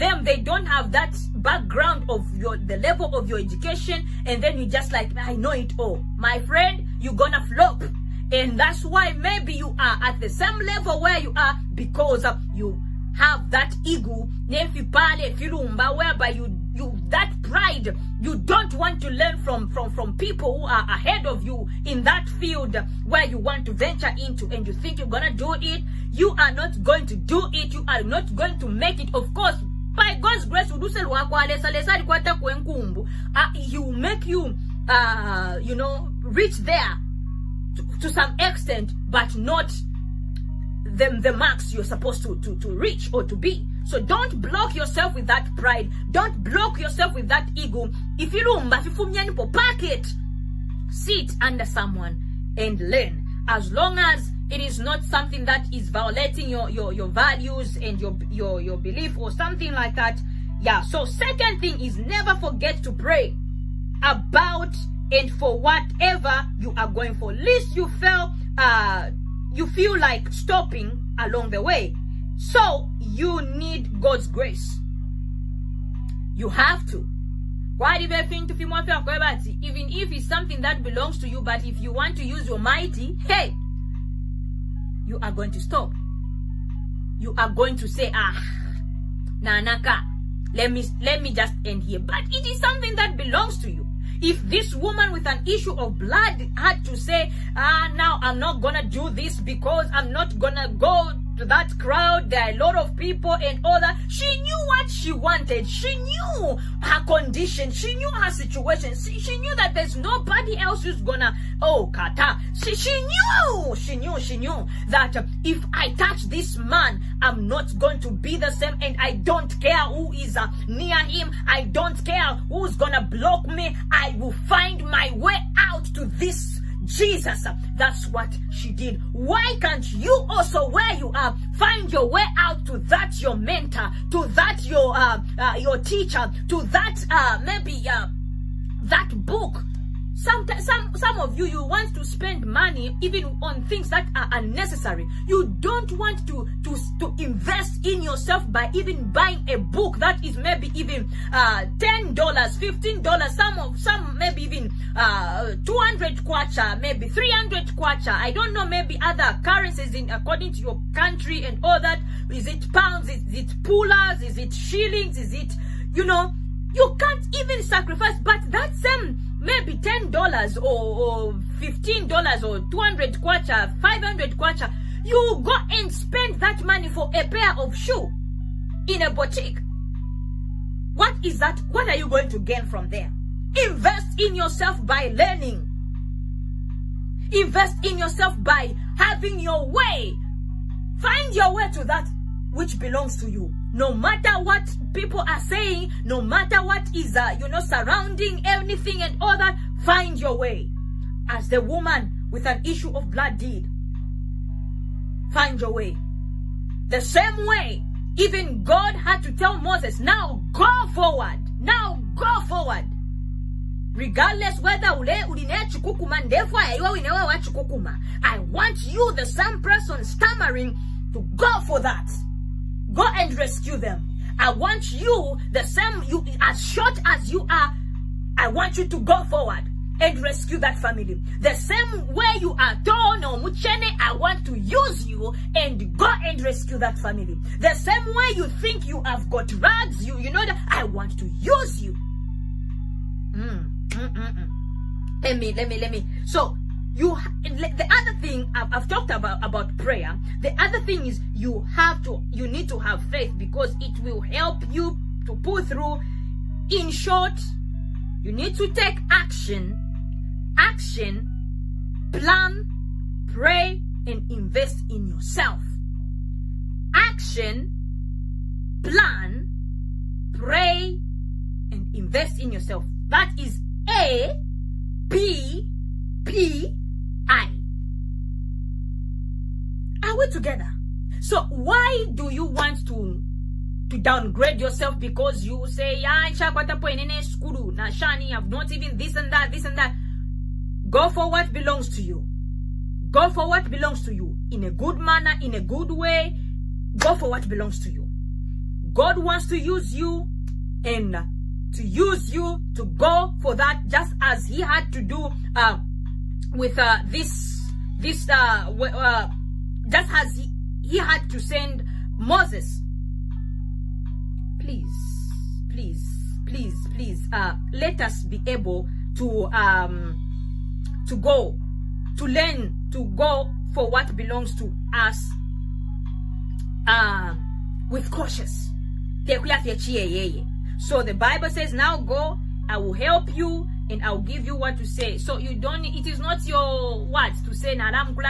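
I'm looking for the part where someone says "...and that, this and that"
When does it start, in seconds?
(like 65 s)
289 s.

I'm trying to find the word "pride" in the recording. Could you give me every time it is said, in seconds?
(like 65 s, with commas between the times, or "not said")
17 s, 45 s.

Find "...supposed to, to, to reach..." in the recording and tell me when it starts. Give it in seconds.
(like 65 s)
41 s.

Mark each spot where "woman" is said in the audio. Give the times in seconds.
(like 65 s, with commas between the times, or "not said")
94 s, 201 s.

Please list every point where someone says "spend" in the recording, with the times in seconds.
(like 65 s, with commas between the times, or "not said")
142 s, 175 s.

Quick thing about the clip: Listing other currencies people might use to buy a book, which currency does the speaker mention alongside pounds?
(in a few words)
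shillings.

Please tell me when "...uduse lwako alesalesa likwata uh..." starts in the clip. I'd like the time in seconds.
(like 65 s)
30 s.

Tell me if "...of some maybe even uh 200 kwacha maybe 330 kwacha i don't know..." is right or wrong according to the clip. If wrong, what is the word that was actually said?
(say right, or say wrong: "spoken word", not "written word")
wrong: "300", not "330".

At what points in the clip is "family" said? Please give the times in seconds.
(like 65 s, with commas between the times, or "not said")
230 s, 236 s.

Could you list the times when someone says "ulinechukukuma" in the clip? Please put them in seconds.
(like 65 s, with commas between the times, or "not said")
215 s.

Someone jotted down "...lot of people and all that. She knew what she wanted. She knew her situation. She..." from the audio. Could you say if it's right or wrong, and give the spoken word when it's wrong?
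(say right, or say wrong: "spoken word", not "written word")
wrong: "condition", not "situation".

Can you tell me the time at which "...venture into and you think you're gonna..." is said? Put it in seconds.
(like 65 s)
23 s.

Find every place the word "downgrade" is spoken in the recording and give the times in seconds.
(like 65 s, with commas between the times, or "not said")
283 s.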